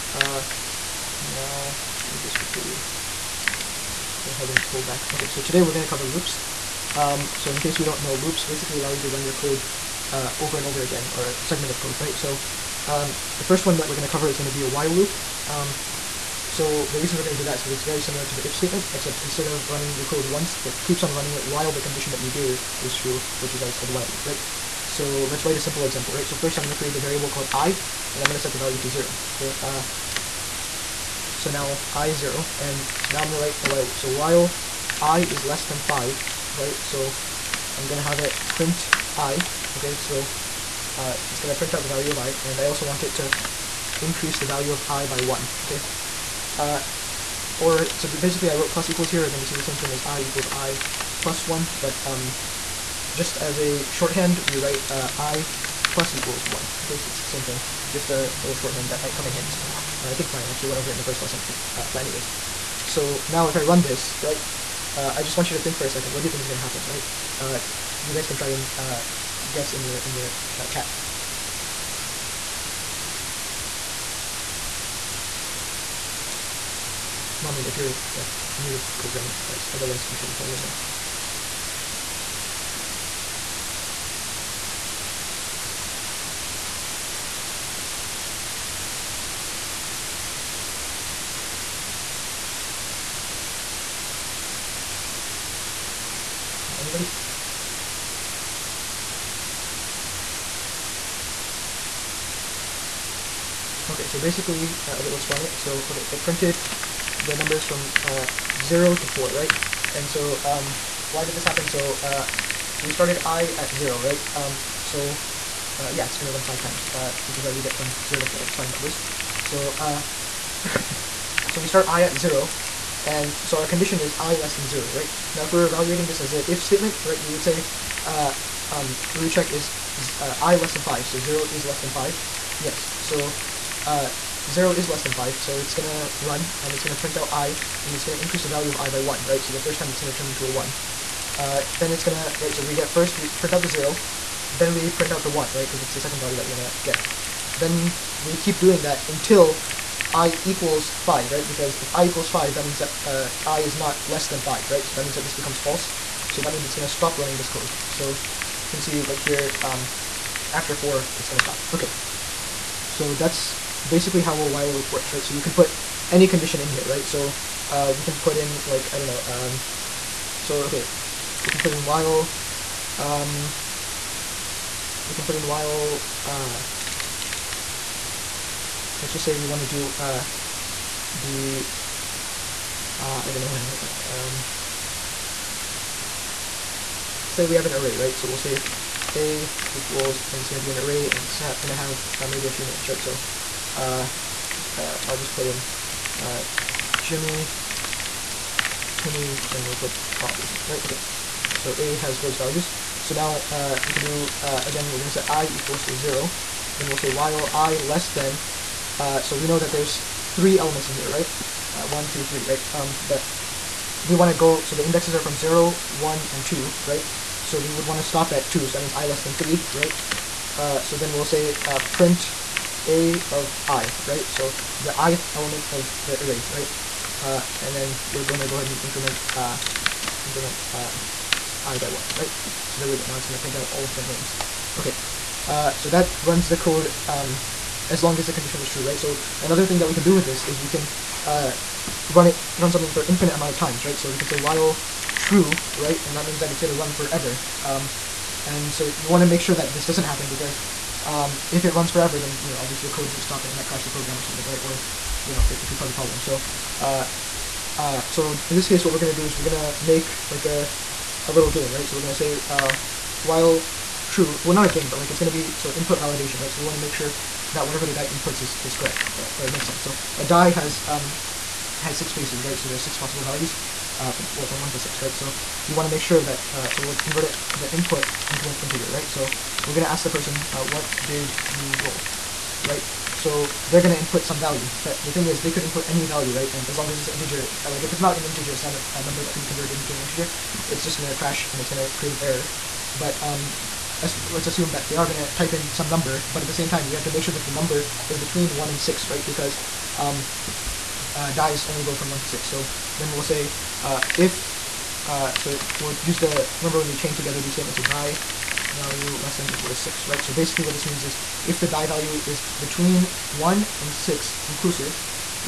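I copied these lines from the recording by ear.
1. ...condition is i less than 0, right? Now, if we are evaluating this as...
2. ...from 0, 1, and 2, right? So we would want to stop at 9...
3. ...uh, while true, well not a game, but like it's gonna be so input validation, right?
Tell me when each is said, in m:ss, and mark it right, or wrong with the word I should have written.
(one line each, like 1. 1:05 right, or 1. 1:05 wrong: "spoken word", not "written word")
1. 2:03 right
2. 3:35 wrong: "2", not "9"
3. 4:22 right.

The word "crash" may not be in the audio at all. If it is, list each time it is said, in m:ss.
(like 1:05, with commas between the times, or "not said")
4:13, 4:51.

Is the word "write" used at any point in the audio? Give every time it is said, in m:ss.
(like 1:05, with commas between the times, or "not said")
0:25, 0:33, 0:54.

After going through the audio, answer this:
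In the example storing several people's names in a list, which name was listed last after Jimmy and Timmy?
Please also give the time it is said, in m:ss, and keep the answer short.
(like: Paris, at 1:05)
Bob, at 3:20.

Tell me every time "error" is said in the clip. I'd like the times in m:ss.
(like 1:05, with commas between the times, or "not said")
4:52.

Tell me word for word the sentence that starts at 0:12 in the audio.
So um, the first one that we're going to cover is going to be a while loop.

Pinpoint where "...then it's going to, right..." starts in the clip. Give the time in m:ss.
2:21.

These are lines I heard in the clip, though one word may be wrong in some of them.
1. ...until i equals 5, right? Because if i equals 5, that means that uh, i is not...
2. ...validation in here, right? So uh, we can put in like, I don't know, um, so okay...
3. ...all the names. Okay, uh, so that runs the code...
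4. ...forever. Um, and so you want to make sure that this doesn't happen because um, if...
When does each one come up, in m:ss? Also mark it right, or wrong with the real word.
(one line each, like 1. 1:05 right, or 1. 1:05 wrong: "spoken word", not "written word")
1. 2:29 right
2. 2:46 wrong: "condition", not "validation"
3. 3:53 right
4. 4:06 right.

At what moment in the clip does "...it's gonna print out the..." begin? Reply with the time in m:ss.
0:41.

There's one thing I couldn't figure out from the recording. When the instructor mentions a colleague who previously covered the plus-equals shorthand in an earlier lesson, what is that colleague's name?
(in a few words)
Brian.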